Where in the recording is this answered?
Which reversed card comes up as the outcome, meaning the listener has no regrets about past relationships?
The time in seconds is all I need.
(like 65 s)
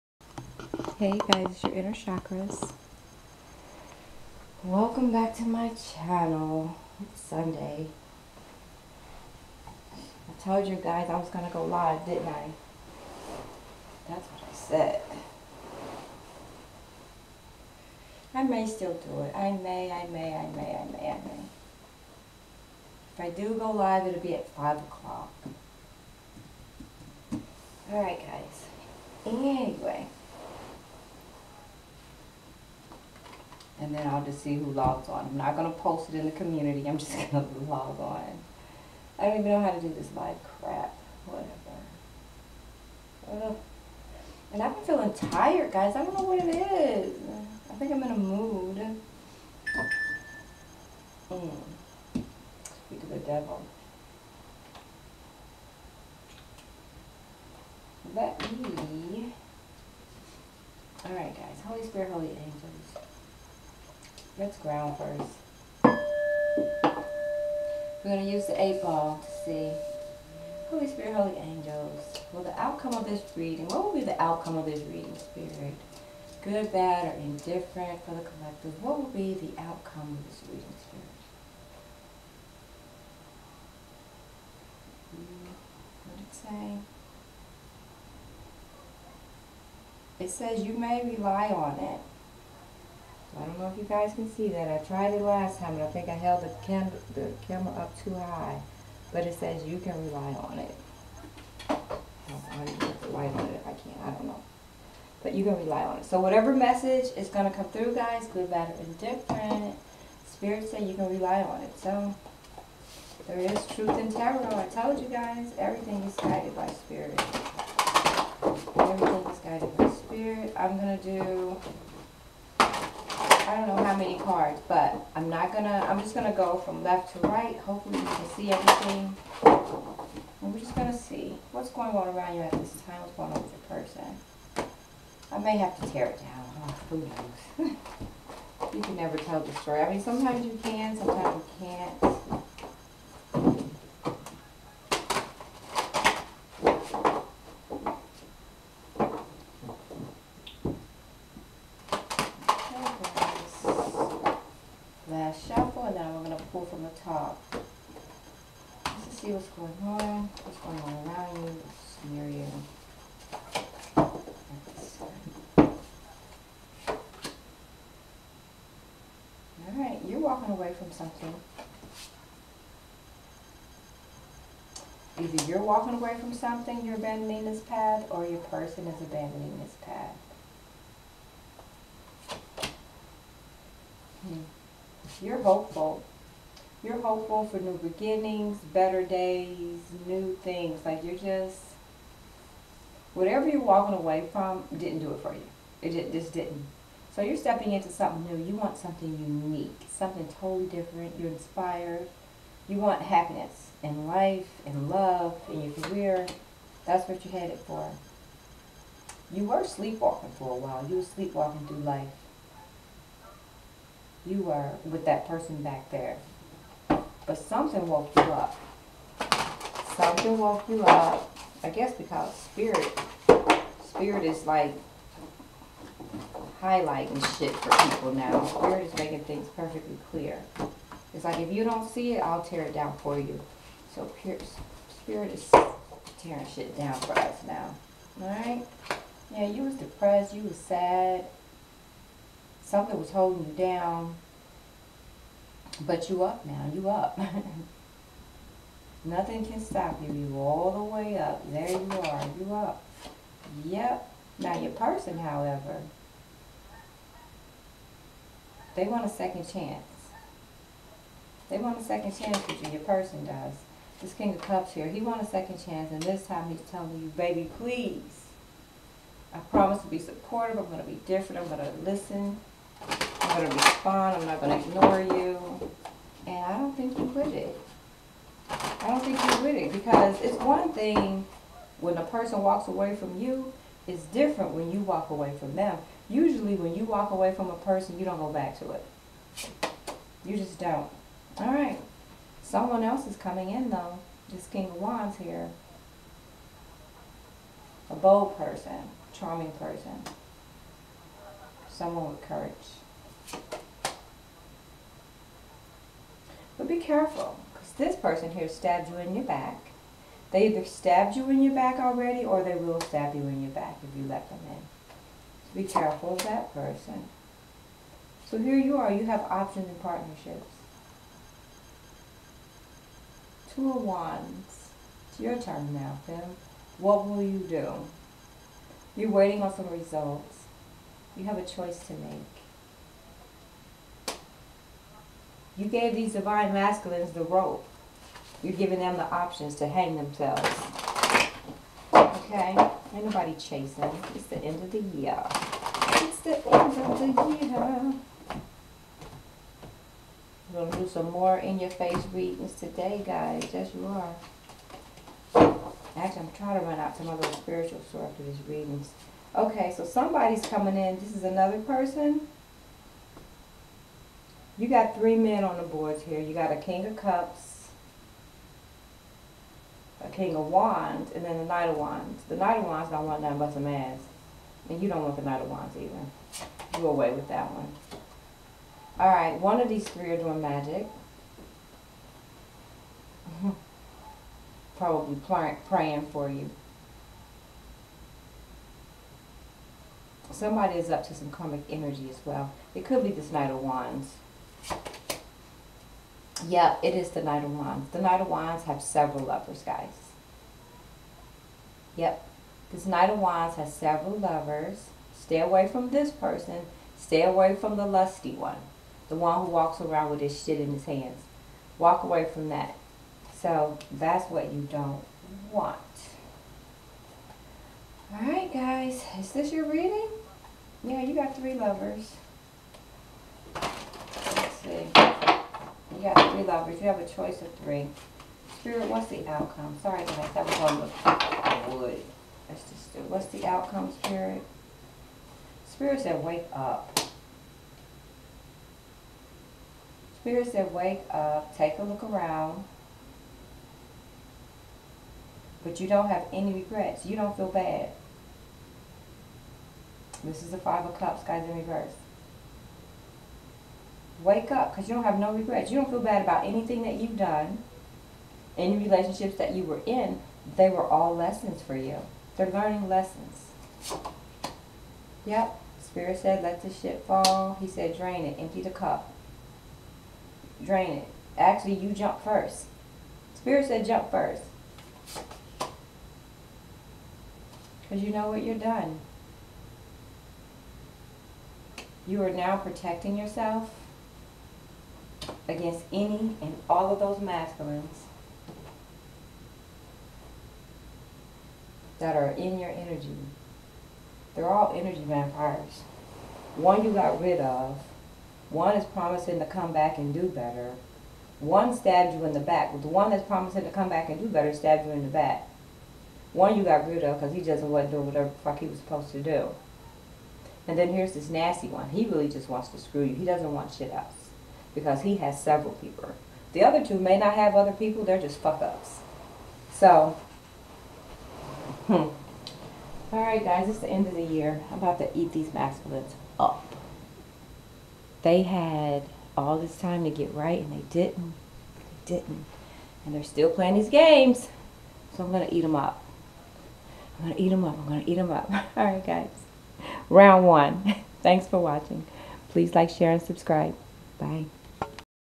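450 s.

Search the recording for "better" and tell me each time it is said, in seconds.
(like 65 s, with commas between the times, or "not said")
188 s, 500 s, 504 s.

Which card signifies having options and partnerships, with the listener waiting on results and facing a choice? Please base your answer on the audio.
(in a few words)
Two of Wands.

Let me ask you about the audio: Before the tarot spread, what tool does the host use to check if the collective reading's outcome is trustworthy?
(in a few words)
eight ball.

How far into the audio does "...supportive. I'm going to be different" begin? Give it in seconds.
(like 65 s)
269 s.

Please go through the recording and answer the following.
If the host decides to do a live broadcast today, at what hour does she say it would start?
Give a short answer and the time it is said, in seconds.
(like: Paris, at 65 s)
5 o'clock, at 24 s.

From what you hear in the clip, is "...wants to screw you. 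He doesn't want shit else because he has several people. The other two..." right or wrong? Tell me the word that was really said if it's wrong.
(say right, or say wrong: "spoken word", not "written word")
right.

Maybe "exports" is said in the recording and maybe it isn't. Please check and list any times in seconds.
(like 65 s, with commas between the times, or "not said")
not said.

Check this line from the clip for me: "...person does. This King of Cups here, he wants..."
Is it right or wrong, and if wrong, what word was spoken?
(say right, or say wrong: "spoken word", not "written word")
right.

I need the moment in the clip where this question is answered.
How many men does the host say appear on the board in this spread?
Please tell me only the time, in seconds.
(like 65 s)
364 s.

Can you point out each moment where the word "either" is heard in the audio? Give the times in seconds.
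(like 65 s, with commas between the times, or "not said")
175 s, 310 s, 375 s.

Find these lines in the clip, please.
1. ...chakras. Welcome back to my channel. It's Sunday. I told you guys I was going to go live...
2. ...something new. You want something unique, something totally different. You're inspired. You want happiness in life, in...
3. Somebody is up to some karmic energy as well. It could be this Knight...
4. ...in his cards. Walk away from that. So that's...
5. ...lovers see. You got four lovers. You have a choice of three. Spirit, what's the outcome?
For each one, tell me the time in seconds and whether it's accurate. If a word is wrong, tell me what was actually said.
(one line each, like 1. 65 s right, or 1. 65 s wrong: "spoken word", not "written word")
1. 1 s right
2. 197 s right
3. 390 s right
4. 410 s wrong: "hands", not "cards"
5. 421 s wrong: "three", not "four".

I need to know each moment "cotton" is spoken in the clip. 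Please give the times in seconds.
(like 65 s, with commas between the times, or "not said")
not said.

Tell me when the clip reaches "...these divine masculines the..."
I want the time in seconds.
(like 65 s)
335 s.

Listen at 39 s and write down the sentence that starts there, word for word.
I don't even know how to do this live crap.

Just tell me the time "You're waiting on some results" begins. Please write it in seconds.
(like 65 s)
328 s.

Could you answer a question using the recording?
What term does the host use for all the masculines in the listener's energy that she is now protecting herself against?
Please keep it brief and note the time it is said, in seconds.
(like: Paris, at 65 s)
energy vampires, at 494 s.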